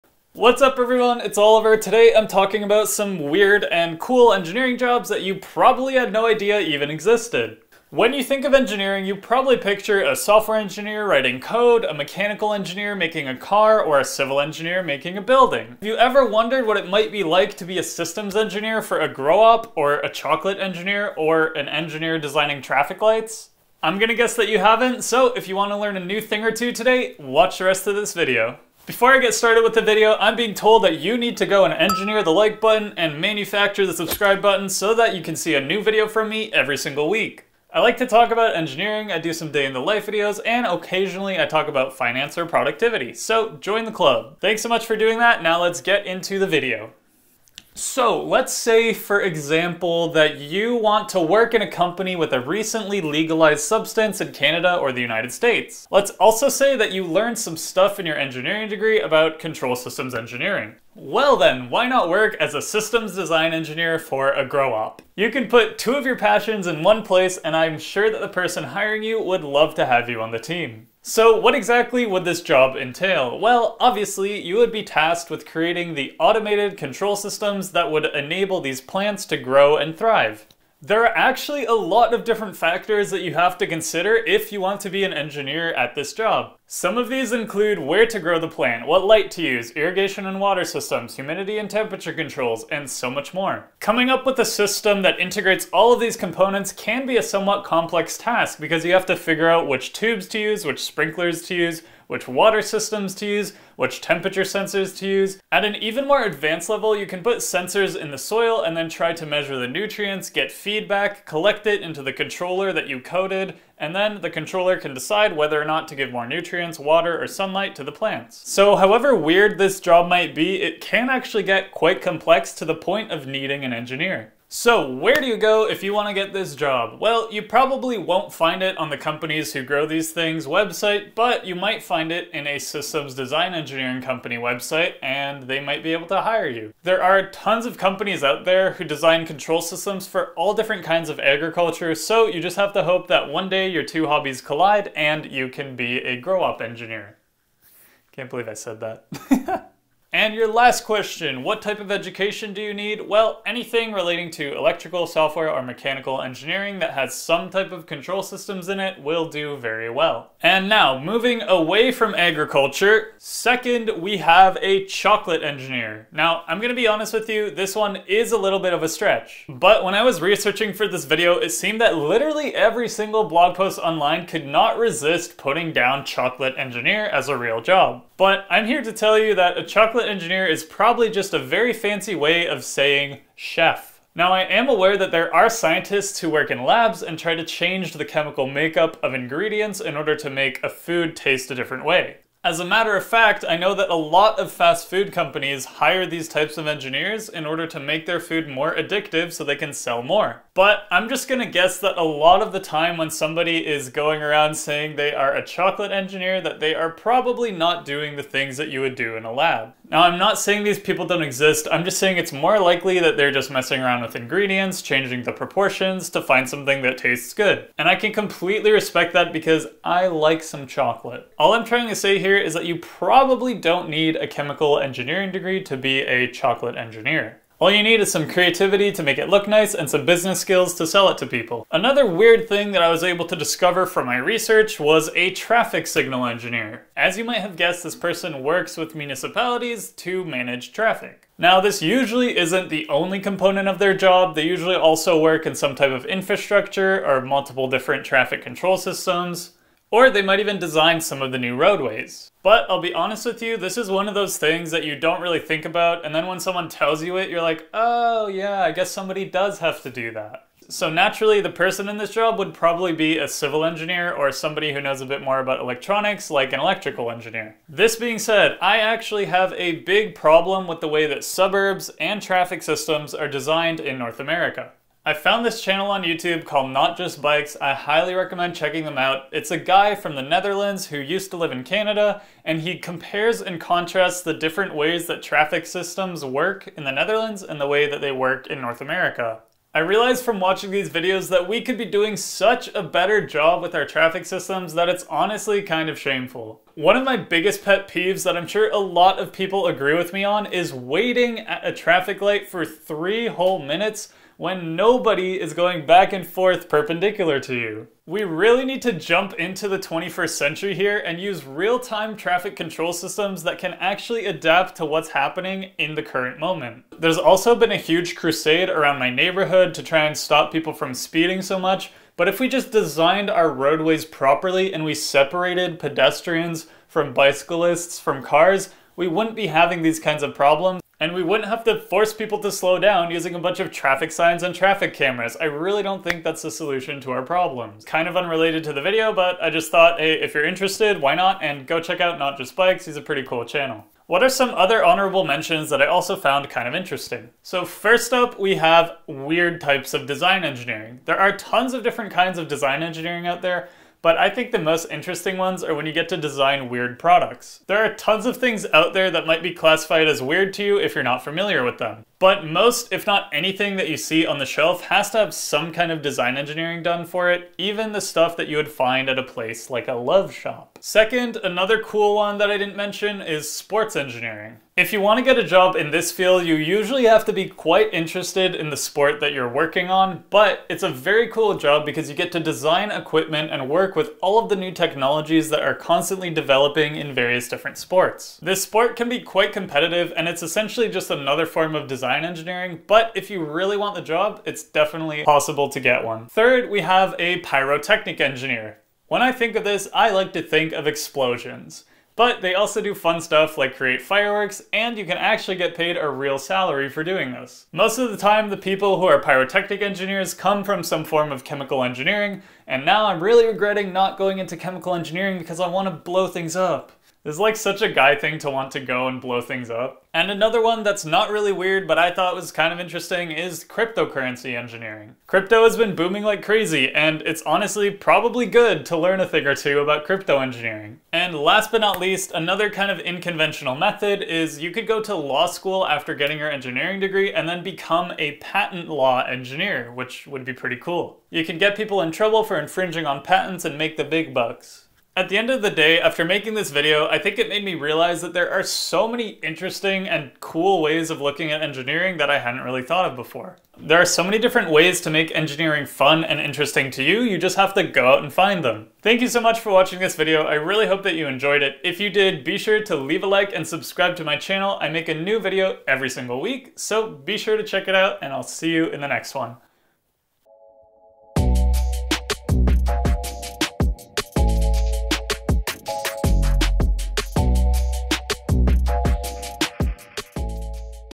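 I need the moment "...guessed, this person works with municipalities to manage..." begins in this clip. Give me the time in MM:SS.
03:57.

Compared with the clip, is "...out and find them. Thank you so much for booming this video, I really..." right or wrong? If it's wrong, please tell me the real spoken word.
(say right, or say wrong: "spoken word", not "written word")
wrong: "watching", not "booming".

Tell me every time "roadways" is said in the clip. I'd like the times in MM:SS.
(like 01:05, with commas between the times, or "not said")
04:11, 05:23.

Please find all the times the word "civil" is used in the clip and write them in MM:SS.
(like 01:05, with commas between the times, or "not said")
00:14, 04:23.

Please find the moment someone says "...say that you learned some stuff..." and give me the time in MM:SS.
00:56.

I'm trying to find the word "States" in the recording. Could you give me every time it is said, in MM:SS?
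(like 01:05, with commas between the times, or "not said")
00:55.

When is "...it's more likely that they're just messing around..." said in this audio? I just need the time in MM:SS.
03:32.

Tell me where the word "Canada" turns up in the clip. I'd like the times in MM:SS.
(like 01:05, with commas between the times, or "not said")
00:54, 04:41.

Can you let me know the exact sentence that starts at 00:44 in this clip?
Thanks so much for doing that, now let's get into the video.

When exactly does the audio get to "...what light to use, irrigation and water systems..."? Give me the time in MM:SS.
01:28.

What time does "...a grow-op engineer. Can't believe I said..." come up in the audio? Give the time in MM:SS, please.
02:25.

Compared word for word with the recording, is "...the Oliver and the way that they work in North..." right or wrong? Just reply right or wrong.
wrong.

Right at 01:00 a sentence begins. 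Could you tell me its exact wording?
Well then, why not work as a systems design engineer for a grow-op?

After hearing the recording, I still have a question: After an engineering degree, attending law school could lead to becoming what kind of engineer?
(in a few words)
patent law engineer.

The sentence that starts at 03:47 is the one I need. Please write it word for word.
All you need is some creativity to make it look nice and some business skills to sell it to people.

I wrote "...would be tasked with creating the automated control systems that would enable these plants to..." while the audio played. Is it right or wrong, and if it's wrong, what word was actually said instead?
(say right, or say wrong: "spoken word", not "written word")
right.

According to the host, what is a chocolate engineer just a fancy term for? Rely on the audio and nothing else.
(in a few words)
chef.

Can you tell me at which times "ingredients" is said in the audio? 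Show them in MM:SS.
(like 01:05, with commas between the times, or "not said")
03:09, 03:34.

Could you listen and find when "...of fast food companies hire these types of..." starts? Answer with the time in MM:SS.
03:14.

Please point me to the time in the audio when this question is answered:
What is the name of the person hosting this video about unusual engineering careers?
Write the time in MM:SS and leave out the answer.
00:01.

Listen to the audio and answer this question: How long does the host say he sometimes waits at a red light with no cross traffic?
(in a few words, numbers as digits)
3 minutes.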